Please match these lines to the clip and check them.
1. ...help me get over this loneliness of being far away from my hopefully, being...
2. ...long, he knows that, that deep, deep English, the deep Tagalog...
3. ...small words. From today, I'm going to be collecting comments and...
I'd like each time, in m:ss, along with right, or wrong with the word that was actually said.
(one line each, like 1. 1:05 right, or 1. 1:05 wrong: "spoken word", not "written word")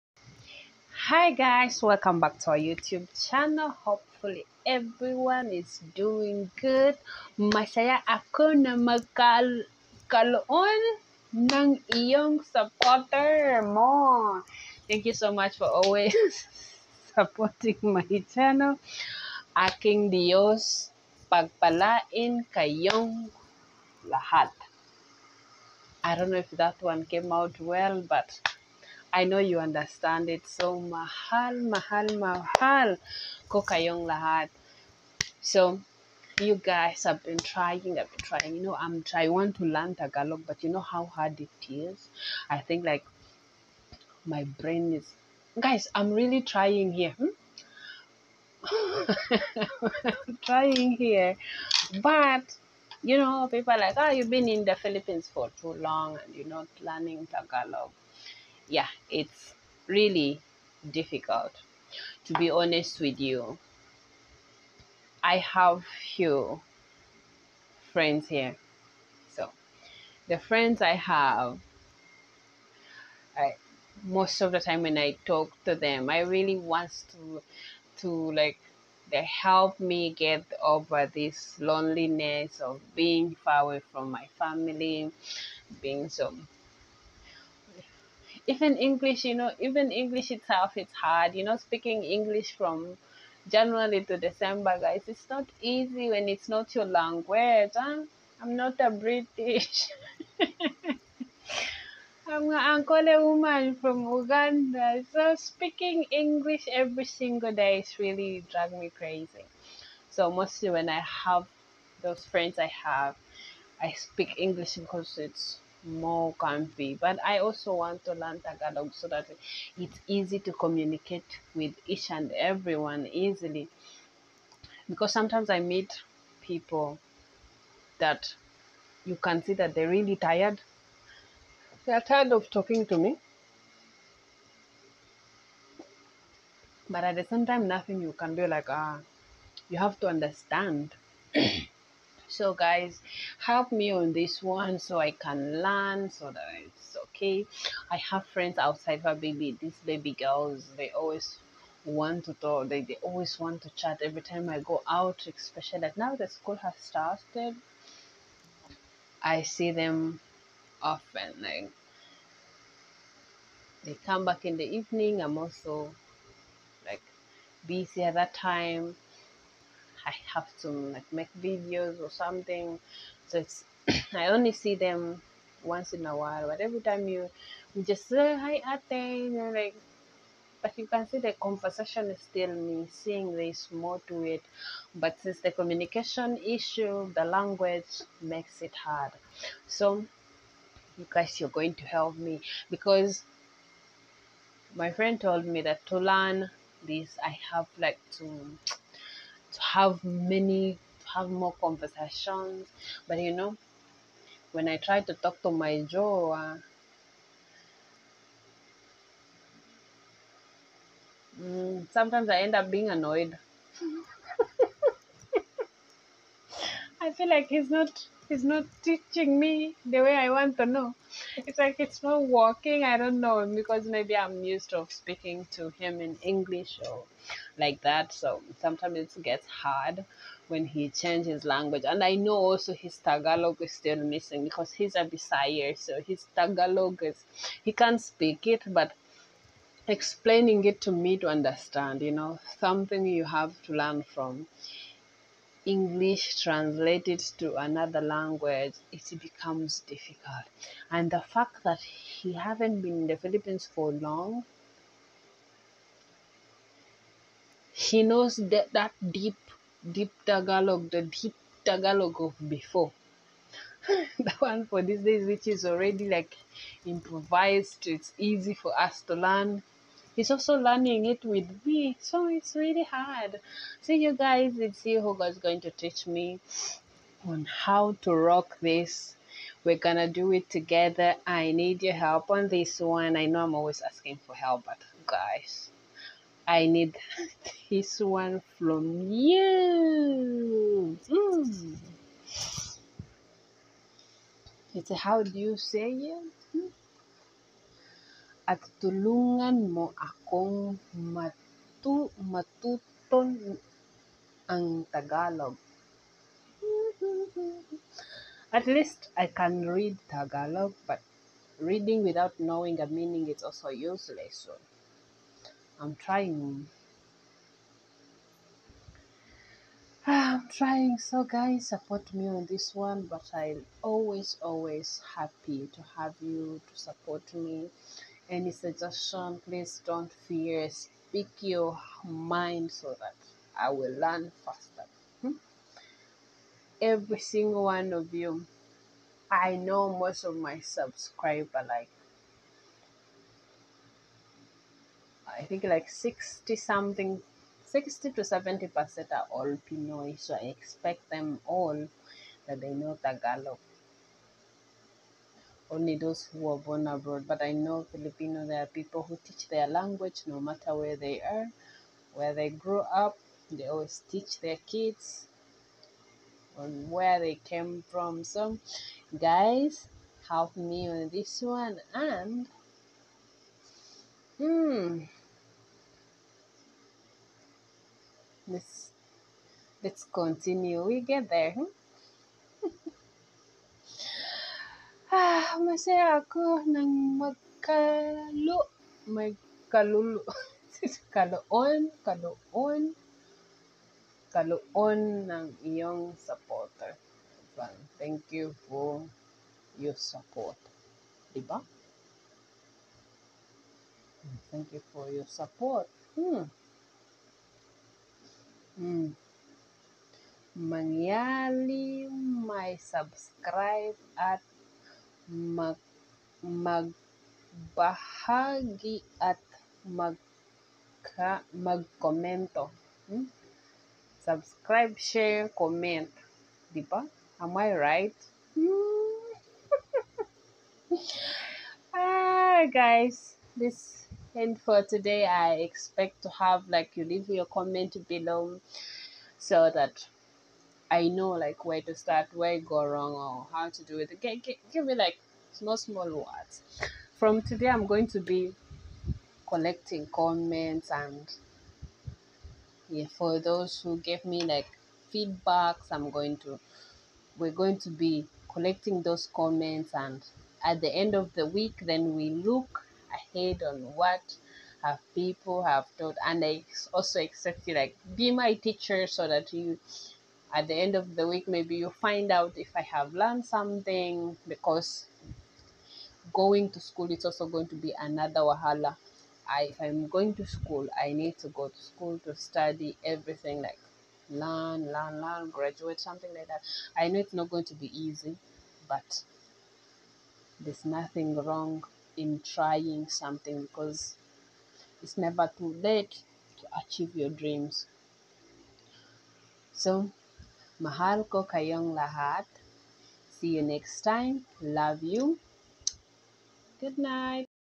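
1. 1:19 wrong: "family", not "hopefully"
2. 4:13 wrong: "Tagalog", not "English"
3. 7:25 right.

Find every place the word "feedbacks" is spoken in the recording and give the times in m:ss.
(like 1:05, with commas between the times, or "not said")
7:35.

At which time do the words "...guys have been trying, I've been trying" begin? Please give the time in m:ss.
0:36.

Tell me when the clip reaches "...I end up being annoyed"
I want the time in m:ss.
3:32.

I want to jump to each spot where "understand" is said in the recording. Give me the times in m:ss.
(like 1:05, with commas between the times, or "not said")
0:29, 2:20, 4:01.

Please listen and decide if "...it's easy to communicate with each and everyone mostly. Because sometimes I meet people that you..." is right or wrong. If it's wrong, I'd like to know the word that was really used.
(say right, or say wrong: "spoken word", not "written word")
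wrong: "easily", not "mostly".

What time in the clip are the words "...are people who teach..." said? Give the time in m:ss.
5:58.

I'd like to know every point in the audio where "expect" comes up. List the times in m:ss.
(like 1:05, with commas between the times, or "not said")
5:50, 7:15, 7:47.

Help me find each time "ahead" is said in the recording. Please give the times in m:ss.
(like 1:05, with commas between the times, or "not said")
7:43.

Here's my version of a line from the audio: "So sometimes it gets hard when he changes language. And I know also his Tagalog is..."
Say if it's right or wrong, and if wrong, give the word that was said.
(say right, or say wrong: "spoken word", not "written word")
right.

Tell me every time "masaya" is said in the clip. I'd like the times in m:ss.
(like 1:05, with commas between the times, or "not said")
0:07, 6:25.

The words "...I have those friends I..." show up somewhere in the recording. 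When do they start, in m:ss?
1:50.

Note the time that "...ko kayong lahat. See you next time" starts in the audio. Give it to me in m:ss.
8:21.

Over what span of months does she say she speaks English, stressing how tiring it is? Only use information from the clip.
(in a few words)
January to December.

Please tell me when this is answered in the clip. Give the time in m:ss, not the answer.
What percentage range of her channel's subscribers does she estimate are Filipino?
5:47.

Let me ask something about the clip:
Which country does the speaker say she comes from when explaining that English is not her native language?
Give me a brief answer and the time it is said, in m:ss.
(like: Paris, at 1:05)
Uganda, at 1:44.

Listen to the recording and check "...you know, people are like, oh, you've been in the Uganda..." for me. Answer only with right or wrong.
wrong.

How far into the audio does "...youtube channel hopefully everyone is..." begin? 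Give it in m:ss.
0:02.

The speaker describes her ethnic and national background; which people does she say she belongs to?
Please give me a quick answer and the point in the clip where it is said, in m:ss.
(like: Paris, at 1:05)
Ankole, at 1:42.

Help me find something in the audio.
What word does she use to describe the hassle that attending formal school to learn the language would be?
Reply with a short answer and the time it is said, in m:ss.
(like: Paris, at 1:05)
wahala, at 7:58.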